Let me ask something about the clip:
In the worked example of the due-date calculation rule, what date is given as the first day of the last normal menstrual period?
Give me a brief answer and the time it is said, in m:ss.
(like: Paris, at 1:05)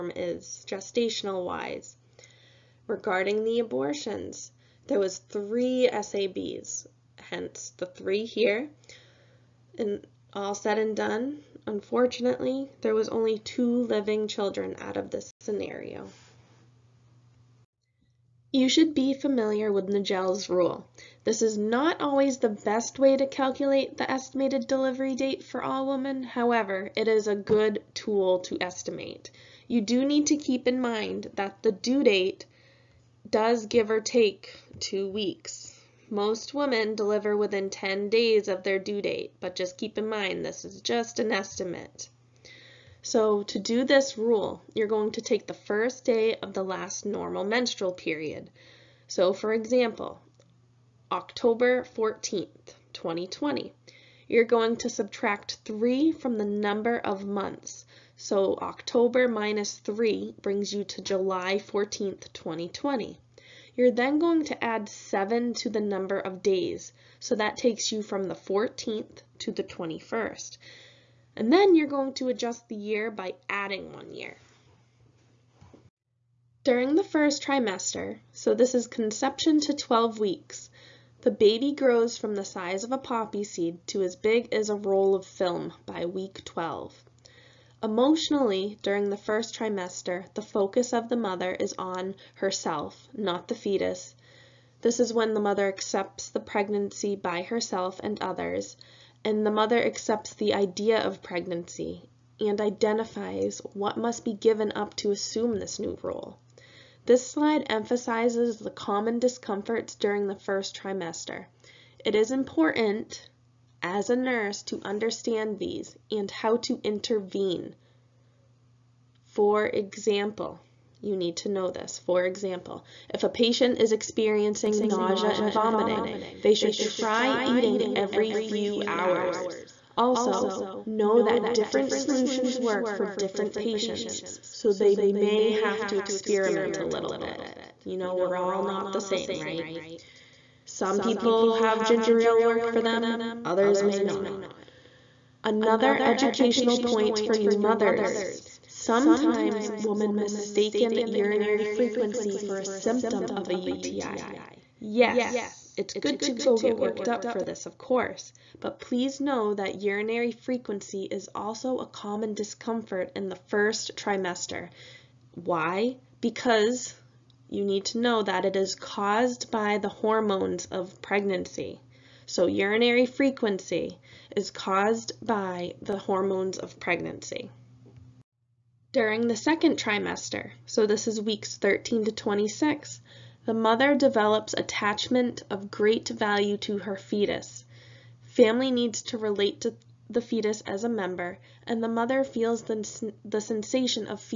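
October 14th, 2020, at 0:51.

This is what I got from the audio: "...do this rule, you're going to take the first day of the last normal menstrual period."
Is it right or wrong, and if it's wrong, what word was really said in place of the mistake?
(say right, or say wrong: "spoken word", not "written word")
right.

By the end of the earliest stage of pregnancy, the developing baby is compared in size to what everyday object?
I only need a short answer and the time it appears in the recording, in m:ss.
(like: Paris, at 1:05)
a roll of film, at 1:24.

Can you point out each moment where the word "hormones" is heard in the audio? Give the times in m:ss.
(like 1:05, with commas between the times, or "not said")
2:49, 2:55.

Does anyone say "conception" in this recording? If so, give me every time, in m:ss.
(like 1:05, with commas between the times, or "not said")
1:18.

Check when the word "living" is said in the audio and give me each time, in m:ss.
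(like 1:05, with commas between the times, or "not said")
0:13.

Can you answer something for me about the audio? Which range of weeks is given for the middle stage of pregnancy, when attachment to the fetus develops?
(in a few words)
13 to 26.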